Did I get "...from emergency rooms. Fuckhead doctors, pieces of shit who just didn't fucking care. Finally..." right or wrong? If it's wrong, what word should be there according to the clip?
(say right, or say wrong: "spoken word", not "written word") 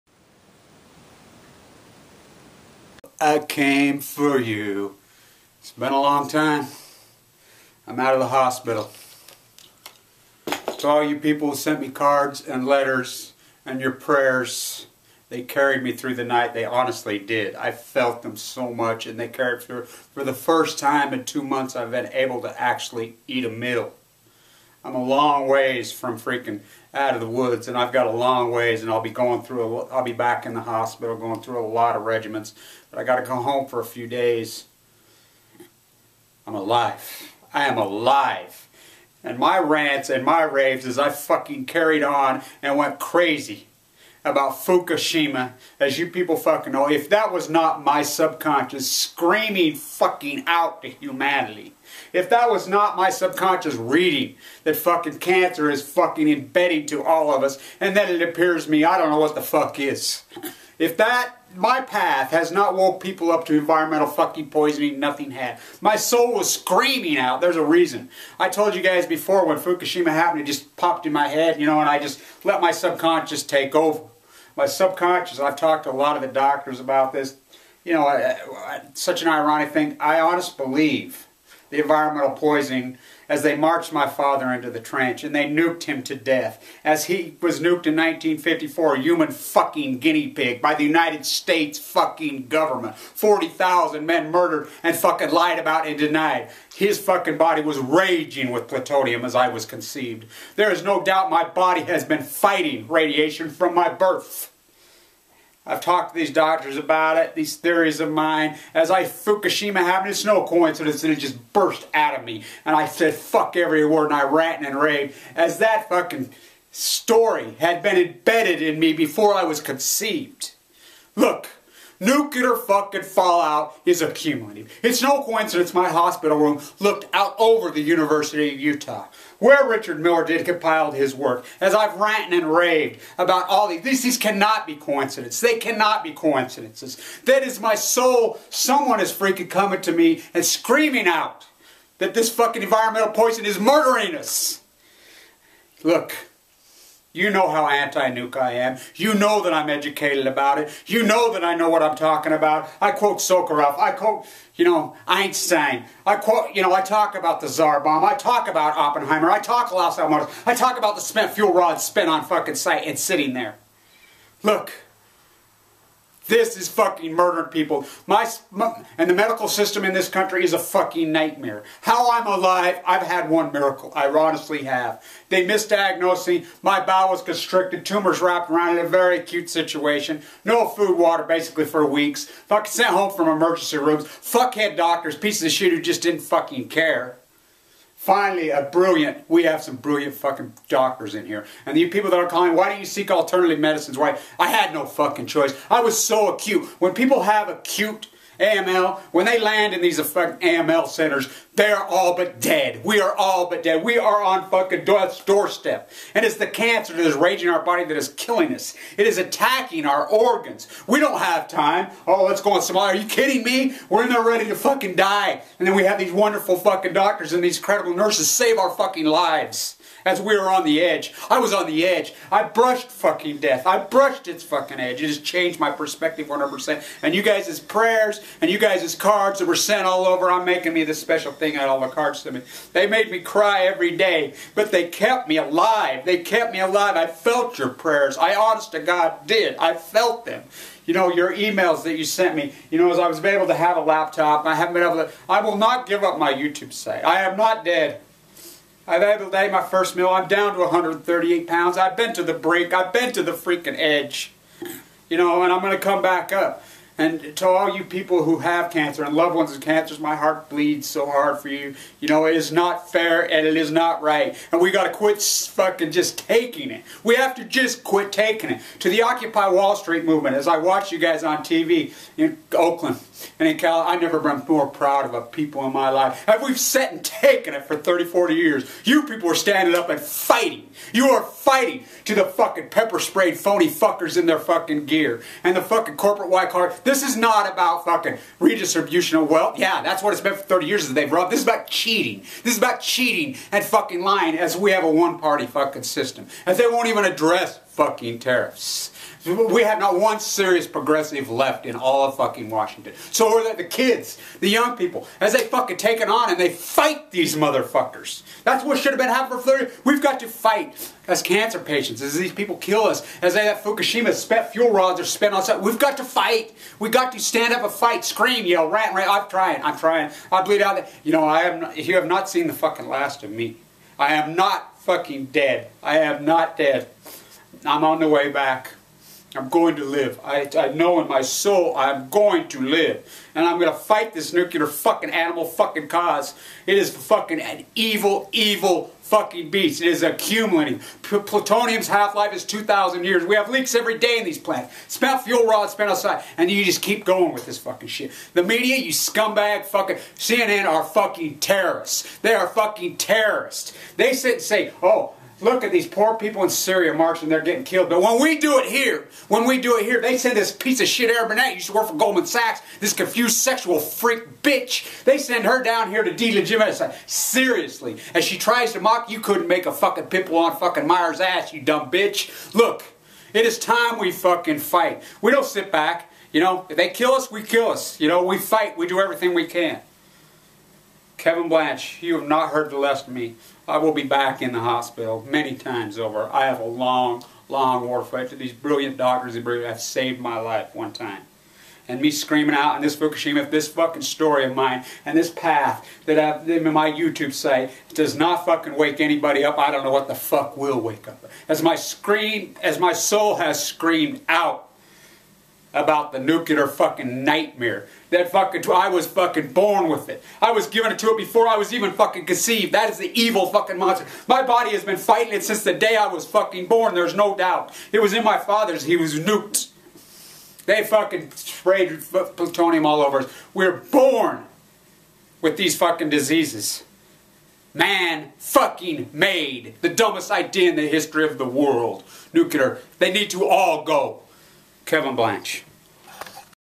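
right.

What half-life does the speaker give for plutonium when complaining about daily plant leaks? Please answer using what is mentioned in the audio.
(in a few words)
2,000 years.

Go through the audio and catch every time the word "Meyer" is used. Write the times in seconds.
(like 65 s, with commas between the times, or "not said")
370 s.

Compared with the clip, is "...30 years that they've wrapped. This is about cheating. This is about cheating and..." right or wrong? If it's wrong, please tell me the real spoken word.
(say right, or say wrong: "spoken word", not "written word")
wrong: "robbed", not "wrapped".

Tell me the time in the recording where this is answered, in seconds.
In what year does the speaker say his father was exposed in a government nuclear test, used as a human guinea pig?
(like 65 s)
87 s.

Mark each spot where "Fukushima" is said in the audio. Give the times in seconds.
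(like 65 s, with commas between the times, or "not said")
44 s, 69 s, 109 s, 313 s, 392 s.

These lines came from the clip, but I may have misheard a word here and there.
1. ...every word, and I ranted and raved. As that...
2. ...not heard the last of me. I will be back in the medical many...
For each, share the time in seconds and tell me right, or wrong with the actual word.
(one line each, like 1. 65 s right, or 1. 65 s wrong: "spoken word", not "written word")
1. 113 s right
2. 382 s wrong: "hospital", not "medical".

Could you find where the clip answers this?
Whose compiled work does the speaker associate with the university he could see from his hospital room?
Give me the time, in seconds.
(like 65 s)
129 s.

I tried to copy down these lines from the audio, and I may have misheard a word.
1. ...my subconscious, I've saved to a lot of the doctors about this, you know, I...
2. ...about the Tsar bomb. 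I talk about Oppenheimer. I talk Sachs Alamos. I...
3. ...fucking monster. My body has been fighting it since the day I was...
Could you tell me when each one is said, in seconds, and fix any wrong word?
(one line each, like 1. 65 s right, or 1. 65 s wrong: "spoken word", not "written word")
1. 74 s wrong: "talked", not "saved"
2. 157 s wrong: "Los", not "Sachs"
3. 413 s right.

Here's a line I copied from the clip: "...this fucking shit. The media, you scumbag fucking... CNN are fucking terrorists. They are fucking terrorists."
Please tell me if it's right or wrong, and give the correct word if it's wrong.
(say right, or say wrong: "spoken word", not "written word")
right.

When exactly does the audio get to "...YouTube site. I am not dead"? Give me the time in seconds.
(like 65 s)
246 s.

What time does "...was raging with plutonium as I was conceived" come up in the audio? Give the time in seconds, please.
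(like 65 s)
97 s.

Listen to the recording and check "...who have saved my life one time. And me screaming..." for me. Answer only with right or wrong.
right.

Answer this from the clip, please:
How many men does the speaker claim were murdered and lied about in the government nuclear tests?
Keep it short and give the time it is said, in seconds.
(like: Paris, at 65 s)
40,000, at 92 s.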